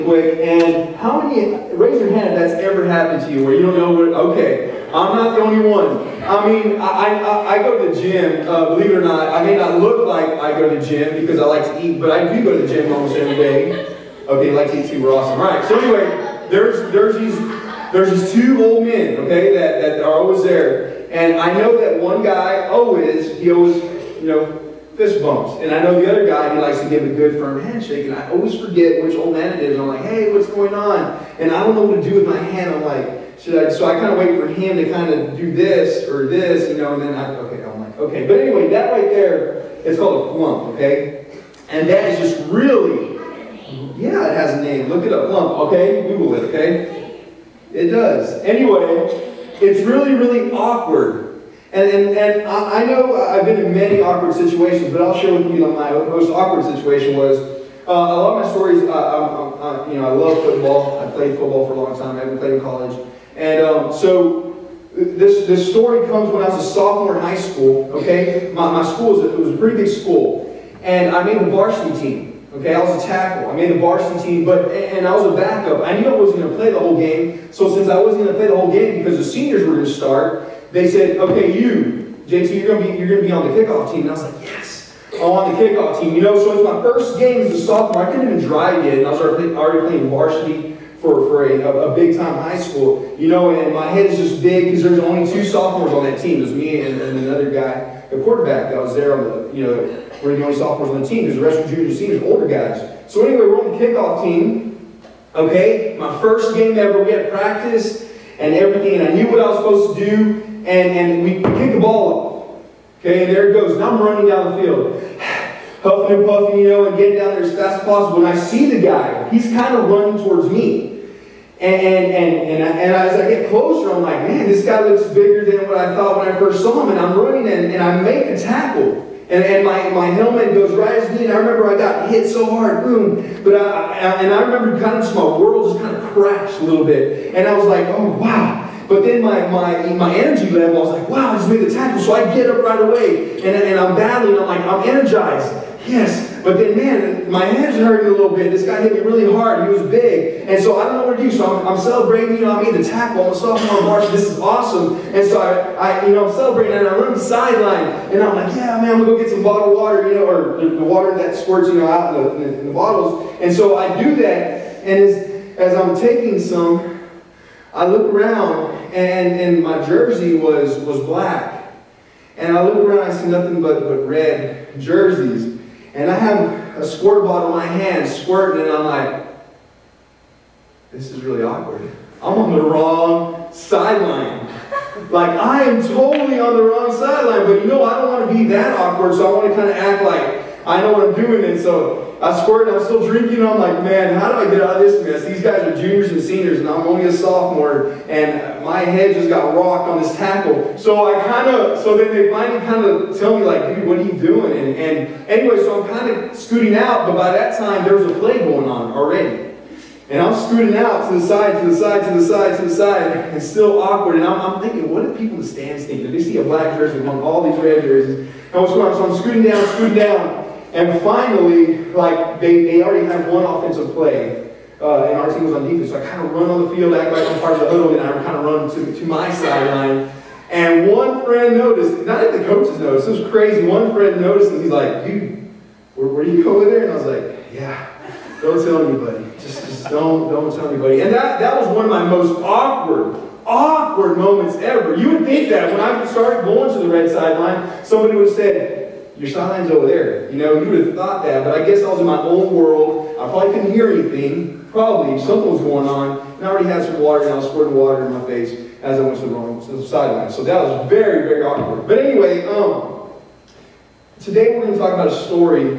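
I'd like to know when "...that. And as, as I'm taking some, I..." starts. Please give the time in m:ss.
2:44.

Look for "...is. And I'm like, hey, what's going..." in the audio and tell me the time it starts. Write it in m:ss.
0:29.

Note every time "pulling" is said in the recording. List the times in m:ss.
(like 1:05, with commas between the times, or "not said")
not said.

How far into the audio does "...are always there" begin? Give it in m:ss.
0:20.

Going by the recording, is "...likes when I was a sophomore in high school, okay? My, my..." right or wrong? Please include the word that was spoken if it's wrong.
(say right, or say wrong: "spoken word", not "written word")
wrong: "comes", not "likes".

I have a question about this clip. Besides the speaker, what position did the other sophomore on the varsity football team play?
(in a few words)
the quarterback.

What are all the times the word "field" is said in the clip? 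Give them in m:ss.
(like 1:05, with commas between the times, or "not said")
1:54, 3:46.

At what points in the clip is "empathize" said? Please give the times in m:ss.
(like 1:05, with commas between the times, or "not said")
not said.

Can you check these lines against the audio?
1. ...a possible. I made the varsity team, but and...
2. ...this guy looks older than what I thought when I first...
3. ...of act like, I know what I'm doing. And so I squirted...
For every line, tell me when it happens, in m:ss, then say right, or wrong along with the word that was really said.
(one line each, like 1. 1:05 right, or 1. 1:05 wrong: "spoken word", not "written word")
1. 1:13 wrong: "tackle", not "possible"
2. 2:04 wrong: "bigger", not "older"
3. 3:09 right.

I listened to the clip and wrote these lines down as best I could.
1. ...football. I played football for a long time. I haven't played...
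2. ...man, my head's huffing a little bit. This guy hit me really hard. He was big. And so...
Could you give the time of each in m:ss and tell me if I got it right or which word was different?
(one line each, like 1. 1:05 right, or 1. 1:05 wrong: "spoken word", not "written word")
1. 1:00 right
2. 2:26 wrong: "hurting", not "huffing".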